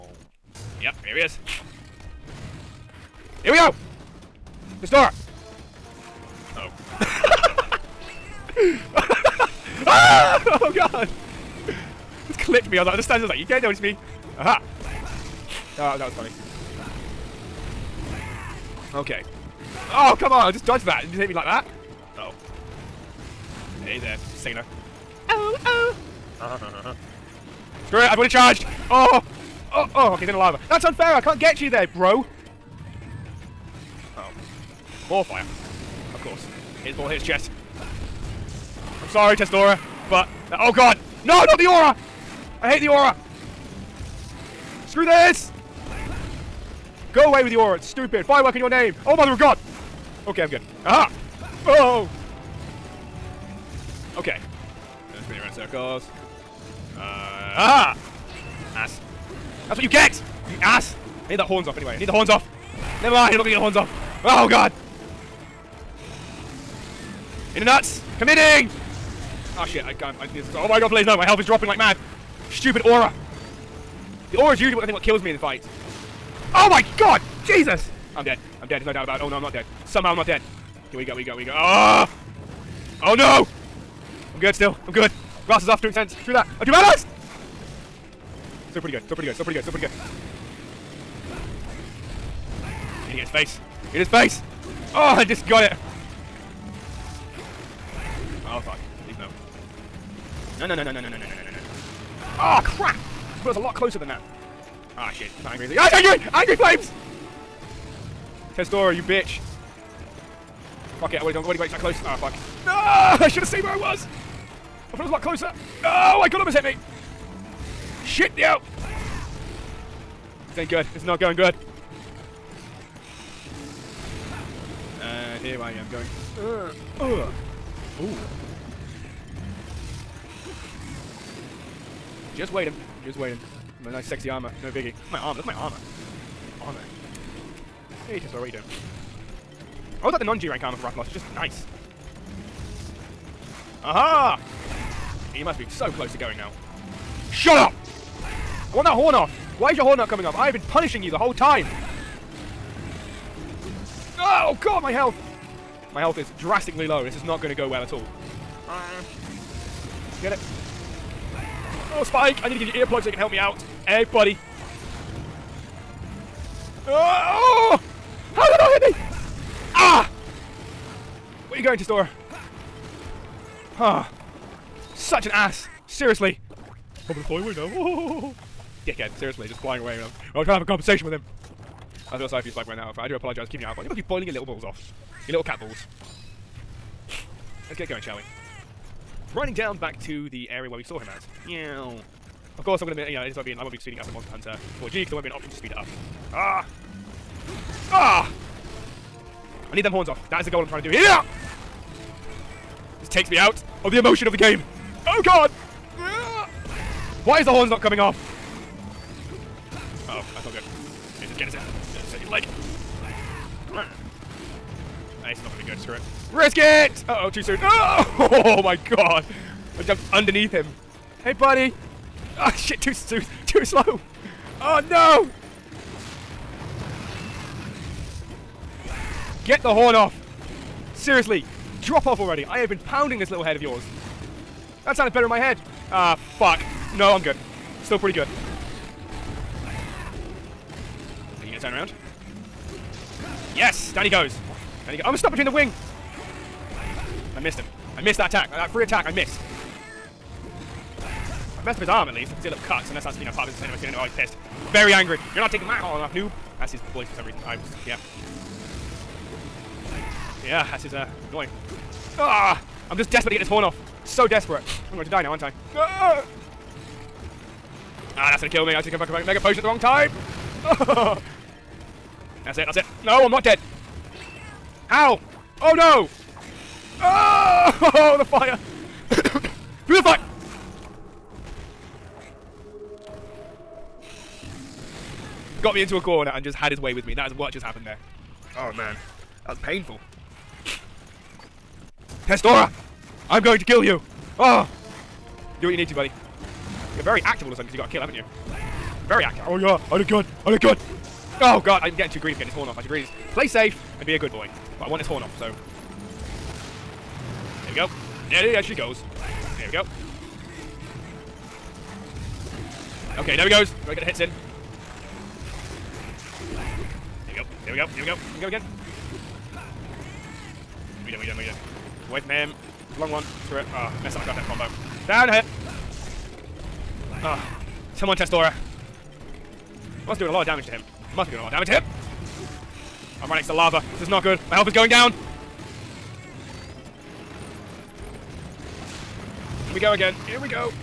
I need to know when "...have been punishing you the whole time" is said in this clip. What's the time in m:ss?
2:30.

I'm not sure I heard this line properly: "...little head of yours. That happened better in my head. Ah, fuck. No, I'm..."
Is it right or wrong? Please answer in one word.
wrong.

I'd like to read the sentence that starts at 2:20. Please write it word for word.
I would like the non-G rank armor for Rathalos.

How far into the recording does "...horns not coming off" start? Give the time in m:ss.
3:27.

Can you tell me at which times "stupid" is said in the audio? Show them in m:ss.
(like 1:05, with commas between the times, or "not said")
0:47, 1:12.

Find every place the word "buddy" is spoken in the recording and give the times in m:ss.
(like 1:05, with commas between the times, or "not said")
2:44, 3:41, 4:55.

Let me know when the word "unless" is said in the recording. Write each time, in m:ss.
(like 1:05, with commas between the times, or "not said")
4:12.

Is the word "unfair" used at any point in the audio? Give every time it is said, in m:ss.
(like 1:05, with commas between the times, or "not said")
0:30.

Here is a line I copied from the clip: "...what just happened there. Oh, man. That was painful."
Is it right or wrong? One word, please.
right.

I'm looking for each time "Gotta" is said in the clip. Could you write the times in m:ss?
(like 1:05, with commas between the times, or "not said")
5:13.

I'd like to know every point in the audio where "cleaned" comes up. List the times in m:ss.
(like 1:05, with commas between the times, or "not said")
not said.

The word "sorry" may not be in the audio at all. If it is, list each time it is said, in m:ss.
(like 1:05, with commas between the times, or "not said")
0:39, 3:02.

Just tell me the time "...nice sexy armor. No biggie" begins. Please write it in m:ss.
2:13.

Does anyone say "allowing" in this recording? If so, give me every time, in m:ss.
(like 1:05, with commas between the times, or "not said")
not said.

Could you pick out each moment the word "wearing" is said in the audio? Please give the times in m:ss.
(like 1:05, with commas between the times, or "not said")
3:02.